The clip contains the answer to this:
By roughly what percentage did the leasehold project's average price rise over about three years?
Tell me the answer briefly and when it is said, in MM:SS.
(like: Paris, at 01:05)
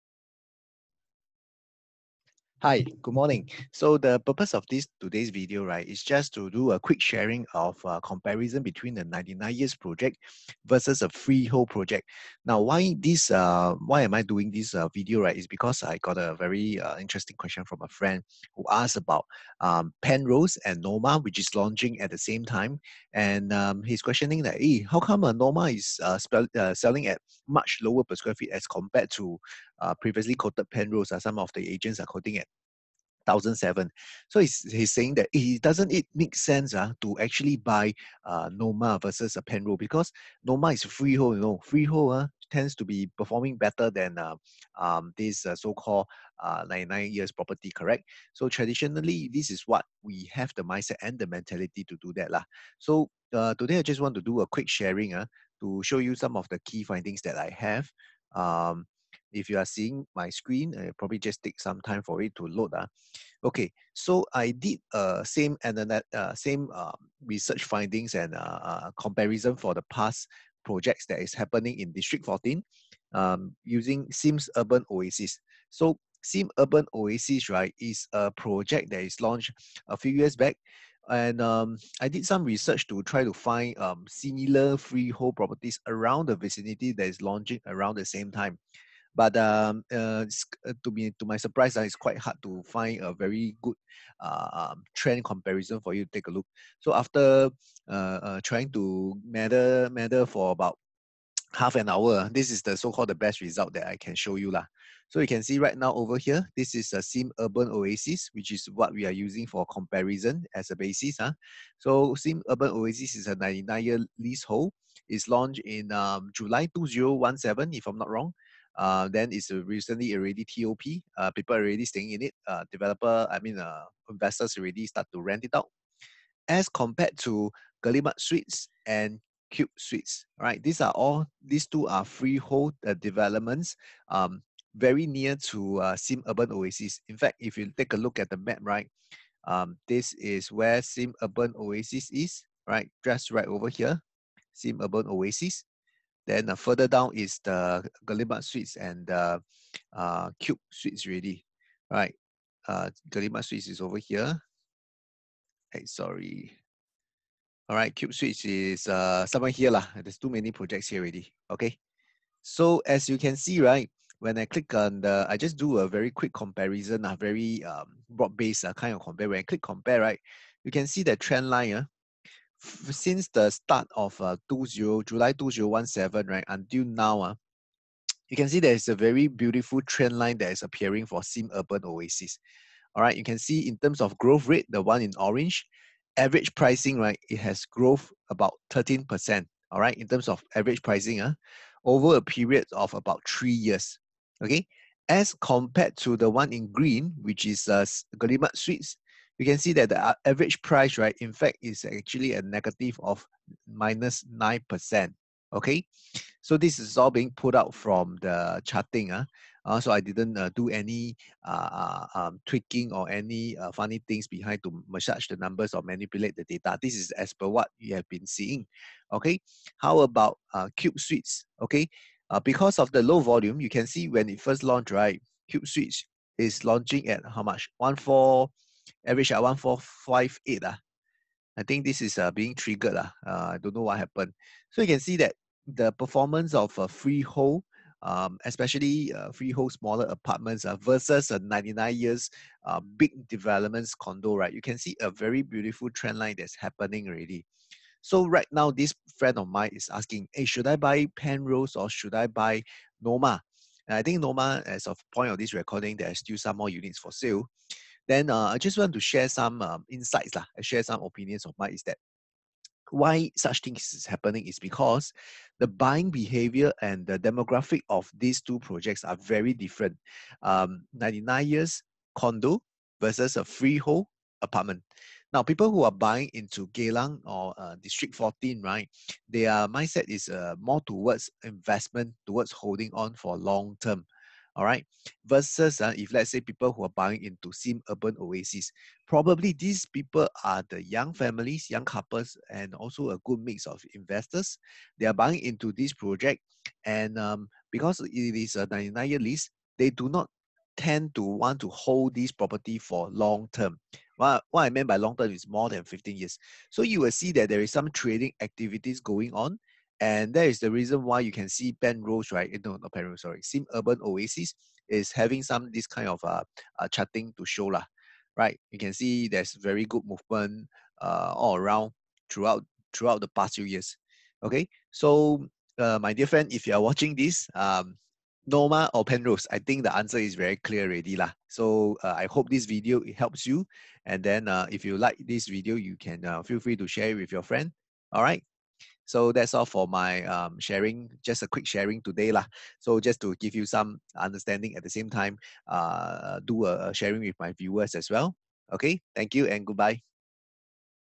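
13%, at 03:08.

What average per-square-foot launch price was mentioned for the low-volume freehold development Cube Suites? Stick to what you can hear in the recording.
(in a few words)
1458.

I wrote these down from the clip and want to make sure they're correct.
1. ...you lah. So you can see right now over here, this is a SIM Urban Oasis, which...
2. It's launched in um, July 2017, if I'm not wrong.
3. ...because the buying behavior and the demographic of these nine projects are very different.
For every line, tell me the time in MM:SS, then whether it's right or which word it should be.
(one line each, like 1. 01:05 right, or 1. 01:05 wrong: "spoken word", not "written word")
1. 01:44 right
2. 01:55 right
3. 04:24 wrong: "two", not "nine".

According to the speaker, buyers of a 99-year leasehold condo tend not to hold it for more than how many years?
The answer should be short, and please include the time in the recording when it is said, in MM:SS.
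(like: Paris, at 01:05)
15 years, at 05:05.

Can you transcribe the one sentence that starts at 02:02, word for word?
Uh, developer, I mean, uh, investors already start to rent it out.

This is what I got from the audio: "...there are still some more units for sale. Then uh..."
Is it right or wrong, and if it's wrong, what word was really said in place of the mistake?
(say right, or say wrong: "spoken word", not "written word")
right.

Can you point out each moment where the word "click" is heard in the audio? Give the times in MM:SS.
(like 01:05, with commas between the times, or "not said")
02:44, 02:49.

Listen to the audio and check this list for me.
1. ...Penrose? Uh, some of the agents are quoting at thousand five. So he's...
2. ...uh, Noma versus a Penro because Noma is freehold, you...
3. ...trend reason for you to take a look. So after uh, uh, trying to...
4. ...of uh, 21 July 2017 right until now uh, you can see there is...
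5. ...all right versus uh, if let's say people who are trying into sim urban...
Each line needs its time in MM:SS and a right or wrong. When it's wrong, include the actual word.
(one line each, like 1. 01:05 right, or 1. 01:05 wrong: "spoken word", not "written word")
1. 00:30 wrong: "seven", not "five"
2. 00:38 right
3. 01:34 wrong: "comparison", not "reason"
4. 02:53 wrong: "20", not "21"
5. 04:44 wrong: "buying", not "trying".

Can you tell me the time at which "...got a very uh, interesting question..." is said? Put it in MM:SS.
00:16.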